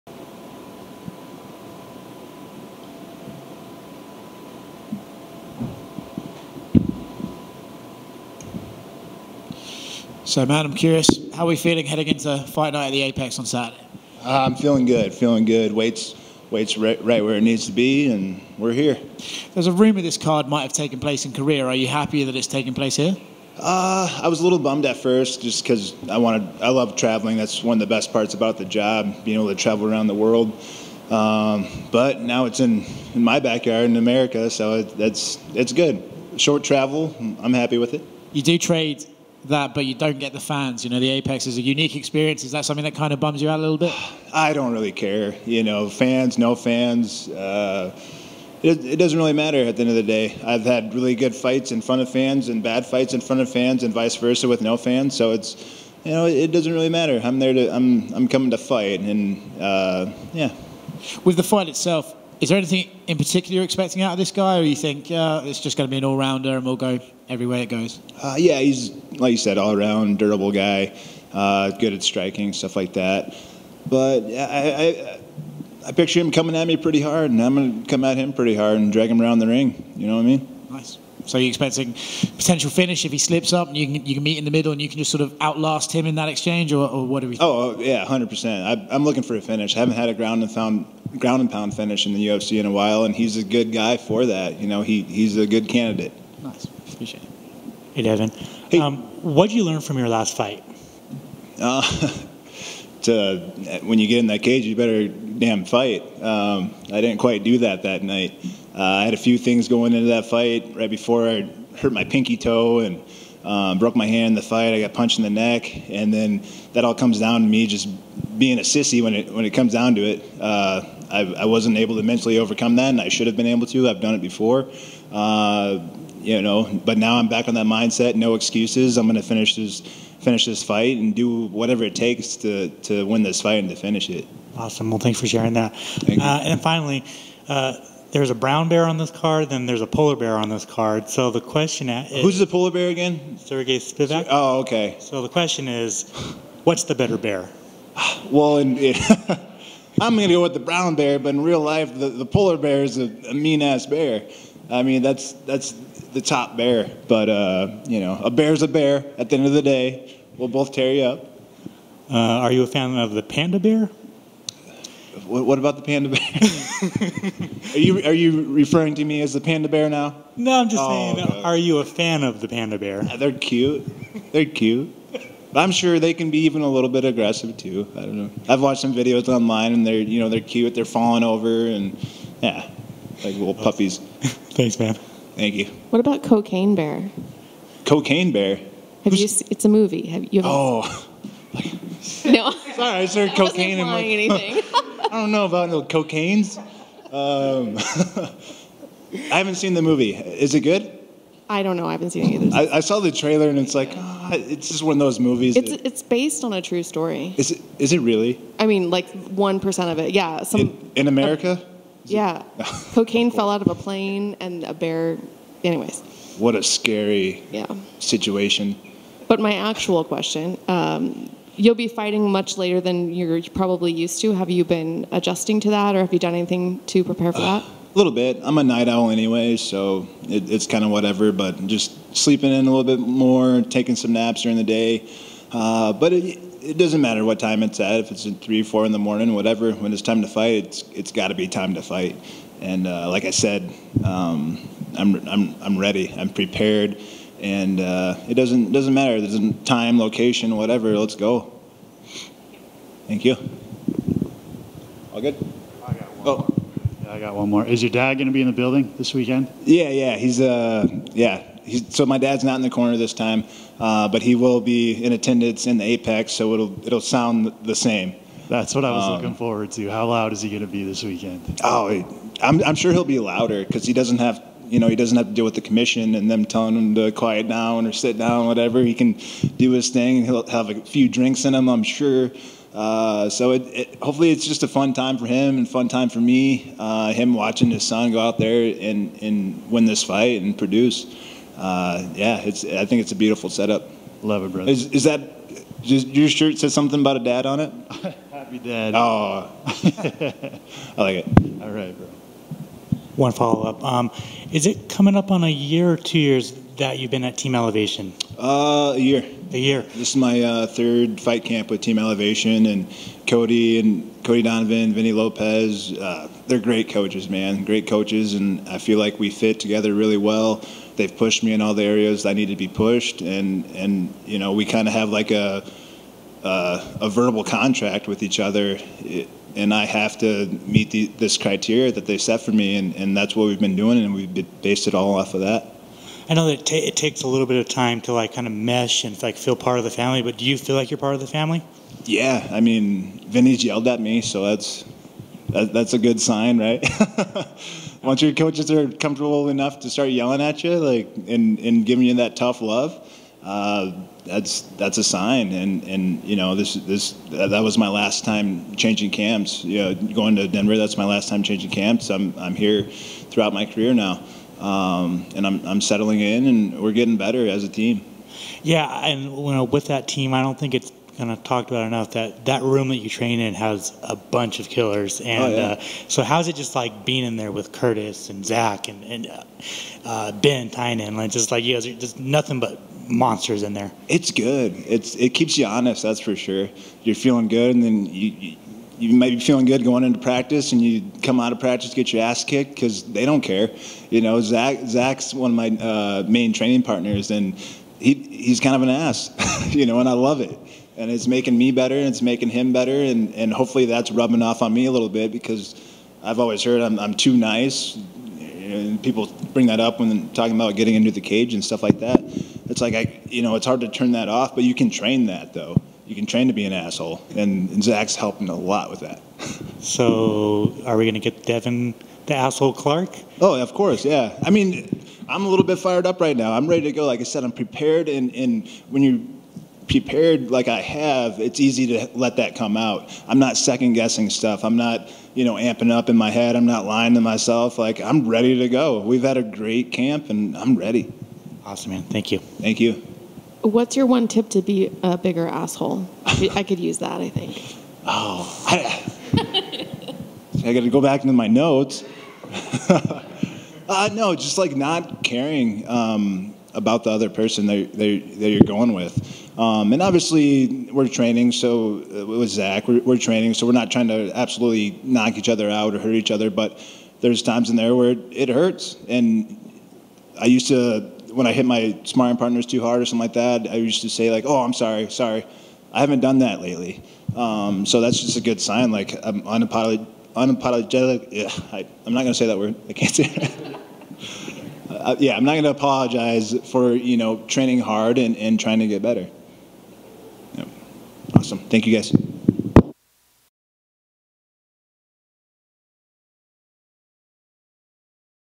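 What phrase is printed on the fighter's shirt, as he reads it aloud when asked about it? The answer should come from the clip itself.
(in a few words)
Happy dad.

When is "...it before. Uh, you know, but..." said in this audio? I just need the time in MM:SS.
02:04.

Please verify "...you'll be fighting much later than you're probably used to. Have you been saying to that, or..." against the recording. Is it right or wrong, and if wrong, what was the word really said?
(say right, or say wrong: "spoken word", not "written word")
wrong: "adjusting", not "saying".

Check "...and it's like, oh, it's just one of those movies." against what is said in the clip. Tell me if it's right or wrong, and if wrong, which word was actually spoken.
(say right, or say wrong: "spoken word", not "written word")
right.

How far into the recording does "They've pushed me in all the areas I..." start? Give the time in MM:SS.
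05:20.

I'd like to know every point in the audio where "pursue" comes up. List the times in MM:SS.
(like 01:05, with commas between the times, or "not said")
not said.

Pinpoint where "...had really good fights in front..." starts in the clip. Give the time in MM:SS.
00:50.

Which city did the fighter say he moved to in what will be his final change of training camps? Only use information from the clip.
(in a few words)
Denver.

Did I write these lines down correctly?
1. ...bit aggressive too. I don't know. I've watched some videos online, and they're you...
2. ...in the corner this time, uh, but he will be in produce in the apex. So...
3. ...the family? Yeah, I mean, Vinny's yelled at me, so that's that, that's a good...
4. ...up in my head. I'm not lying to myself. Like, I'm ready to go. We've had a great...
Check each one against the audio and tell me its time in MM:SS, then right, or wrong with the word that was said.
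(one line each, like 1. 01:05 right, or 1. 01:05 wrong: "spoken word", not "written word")
1. 02:56 right
2. 04:22 wrong: "attendance", not "produce"
3. 05:41 right
4. 07:15 right.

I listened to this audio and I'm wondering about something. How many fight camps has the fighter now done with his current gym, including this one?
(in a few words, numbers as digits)
3.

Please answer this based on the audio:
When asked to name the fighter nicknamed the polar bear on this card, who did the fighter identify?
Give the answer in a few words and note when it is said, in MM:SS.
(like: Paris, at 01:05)
Sergey Spivak, at 02:23.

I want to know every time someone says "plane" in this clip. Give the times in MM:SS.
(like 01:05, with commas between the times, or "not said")
03:33.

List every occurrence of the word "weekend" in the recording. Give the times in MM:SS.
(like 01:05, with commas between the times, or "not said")
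04:19, 04:31.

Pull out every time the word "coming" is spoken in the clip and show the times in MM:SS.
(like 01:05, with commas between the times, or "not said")
00:58, 01:16, 05:04.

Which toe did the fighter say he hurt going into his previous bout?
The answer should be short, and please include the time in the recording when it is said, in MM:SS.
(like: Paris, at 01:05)
Pinky toe, at 01:52.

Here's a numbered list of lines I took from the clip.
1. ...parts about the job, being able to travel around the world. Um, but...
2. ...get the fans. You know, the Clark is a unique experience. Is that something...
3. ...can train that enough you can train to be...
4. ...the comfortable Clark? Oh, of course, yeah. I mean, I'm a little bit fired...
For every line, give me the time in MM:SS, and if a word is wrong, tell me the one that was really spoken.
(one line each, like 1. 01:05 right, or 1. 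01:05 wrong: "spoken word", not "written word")
1. 00:28 right
2. 00:40 wrong: "Apex", not "Clark"
3. 06:54 wrong: "though", not "enough"
4. 07:02 wrong: "asshole", not "comfortable".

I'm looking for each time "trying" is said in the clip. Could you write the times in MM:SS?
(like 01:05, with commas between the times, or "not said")
07:43, 08:08.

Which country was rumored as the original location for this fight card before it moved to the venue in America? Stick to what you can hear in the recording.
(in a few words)
Korea.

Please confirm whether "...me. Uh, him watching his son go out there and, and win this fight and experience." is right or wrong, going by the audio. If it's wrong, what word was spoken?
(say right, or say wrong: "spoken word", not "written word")
wrong: "produce", not "experience".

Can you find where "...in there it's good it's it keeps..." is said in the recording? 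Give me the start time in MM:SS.
06:23.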